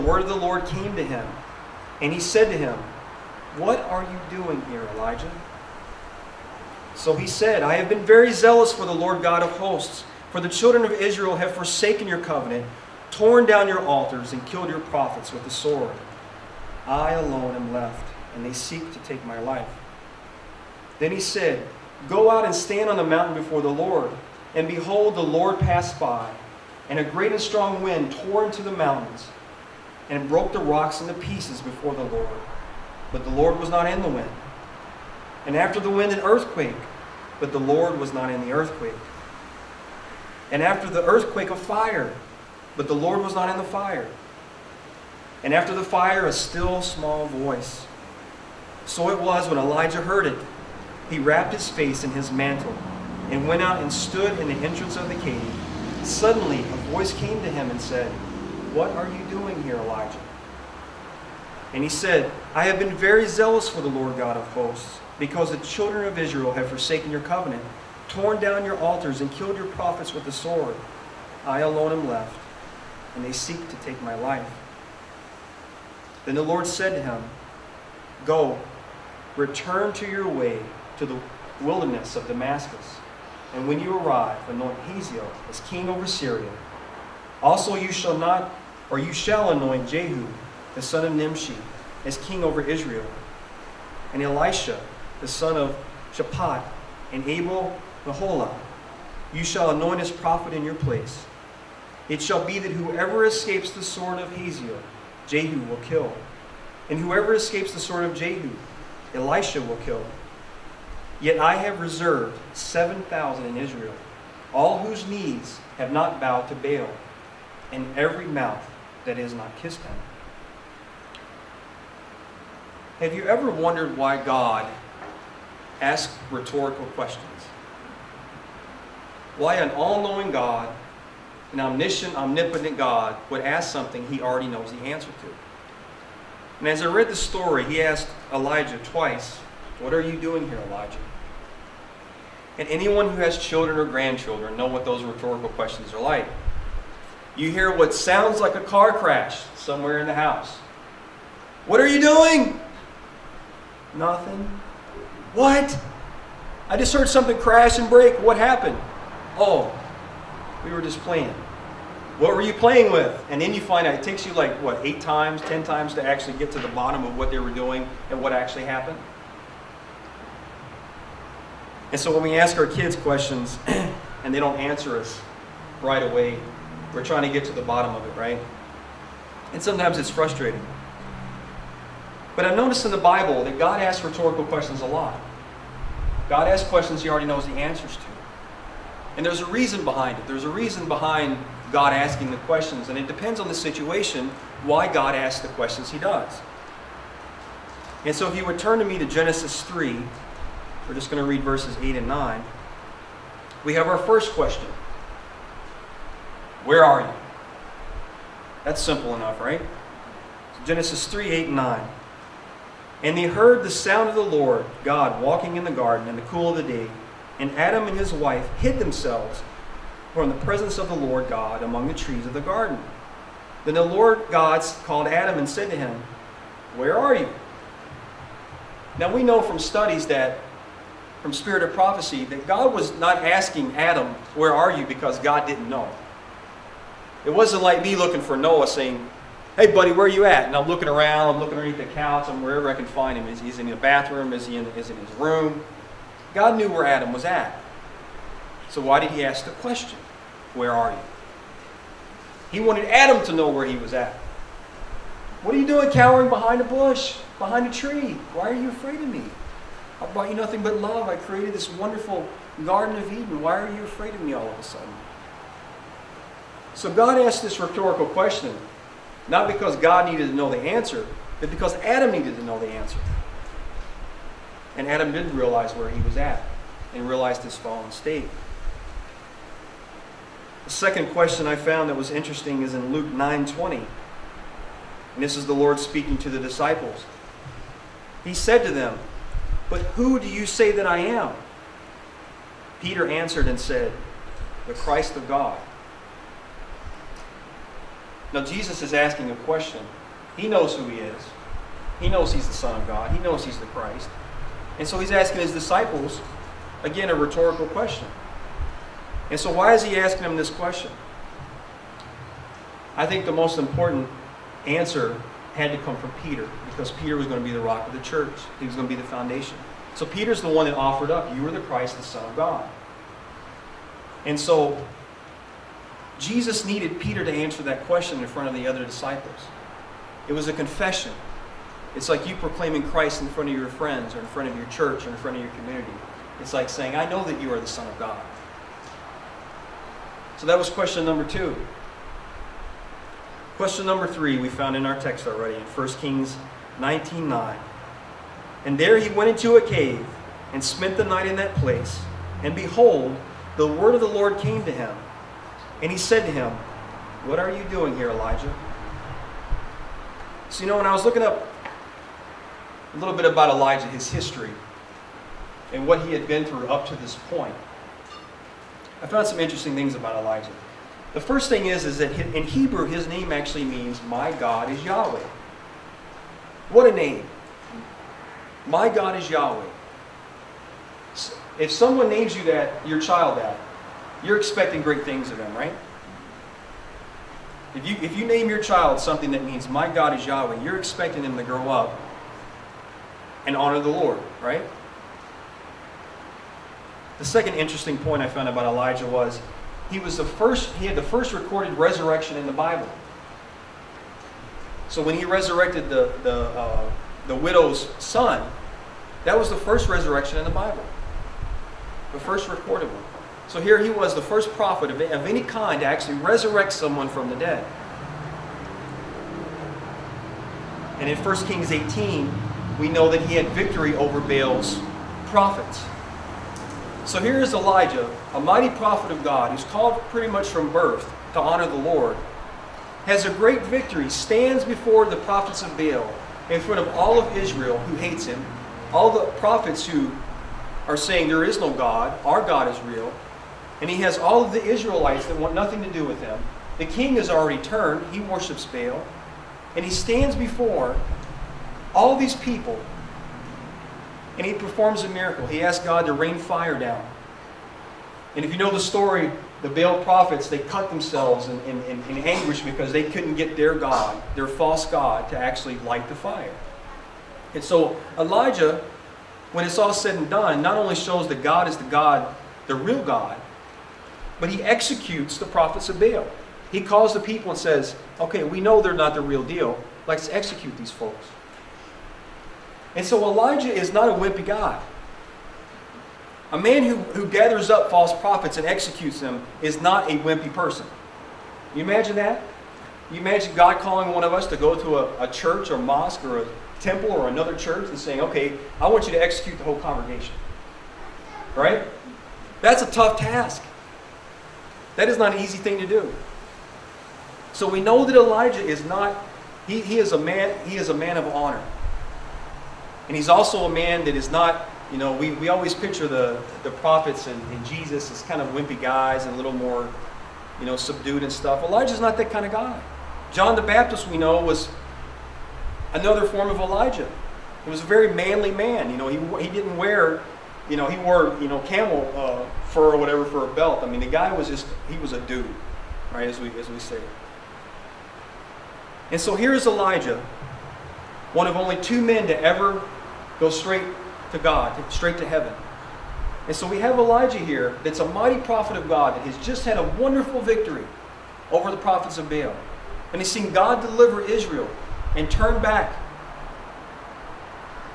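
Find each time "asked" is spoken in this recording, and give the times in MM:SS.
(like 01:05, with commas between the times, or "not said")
02:17, 04:27.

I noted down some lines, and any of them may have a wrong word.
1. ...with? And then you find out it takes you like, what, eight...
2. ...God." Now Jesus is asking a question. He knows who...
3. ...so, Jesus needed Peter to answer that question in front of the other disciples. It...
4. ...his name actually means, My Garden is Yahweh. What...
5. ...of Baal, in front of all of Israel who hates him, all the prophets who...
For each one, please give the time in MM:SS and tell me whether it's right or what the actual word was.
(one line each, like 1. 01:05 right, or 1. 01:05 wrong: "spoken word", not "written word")
1. 02:42 right
2. 04:55 right
3. 05:24 right
4. 06:12 wrong: "God", not "Garden"
5. 07:15 right.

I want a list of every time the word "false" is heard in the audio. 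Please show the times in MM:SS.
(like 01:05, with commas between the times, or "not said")
07:44, 08:07.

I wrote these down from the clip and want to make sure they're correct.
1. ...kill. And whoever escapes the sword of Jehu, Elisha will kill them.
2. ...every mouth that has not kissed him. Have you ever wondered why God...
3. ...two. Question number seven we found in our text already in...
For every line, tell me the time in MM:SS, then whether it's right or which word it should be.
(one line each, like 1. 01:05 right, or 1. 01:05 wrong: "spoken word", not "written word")
1. 01:45 right
2. 01:57 right
3. 05:41 wrong: "three", not "seven".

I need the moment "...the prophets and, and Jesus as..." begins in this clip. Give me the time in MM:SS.
08:36.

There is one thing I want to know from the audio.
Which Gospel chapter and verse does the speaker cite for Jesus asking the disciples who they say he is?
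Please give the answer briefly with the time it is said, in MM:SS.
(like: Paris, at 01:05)
Luke 9:20, at 04:42.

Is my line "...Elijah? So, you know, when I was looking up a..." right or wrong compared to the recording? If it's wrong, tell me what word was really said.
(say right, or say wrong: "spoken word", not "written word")
right.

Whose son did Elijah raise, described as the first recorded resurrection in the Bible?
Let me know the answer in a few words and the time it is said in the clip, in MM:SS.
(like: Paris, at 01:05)
the widow's son, at 06:47.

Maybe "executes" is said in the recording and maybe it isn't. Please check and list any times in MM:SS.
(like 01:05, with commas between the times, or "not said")
07:54, 08:00, 08:08, 08:19.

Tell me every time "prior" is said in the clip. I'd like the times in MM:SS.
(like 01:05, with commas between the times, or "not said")
not said.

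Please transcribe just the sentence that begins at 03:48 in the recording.
Now we know from studies that, from spirit of prophecy, that God was not asking Adam, Where are you?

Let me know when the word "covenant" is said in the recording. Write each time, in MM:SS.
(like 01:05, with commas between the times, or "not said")
00:12, 01:07.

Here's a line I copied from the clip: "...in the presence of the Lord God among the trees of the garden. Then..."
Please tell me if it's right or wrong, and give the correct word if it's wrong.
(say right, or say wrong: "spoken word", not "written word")
right.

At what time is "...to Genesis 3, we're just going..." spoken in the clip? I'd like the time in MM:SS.
03:18.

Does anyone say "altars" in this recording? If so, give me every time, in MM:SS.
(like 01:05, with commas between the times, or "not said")
00:13, 01:08.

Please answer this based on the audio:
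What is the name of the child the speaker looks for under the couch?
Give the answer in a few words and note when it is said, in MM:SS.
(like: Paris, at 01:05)
Noah, at 03:58.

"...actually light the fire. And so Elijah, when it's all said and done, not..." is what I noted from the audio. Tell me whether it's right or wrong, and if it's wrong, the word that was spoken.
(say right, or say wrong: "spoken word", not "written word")
right.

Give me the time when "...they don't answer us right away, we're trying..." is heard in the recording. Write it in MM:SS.
02:54.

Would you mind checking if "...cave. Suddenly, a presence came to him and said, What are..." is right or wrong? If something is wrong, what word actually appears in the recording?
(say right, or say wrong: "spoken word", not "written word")
wrong: "voice", not "presence".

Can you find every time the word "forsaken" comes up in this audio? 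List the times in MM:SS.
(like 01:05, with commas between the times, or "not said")
00:11, 01:06.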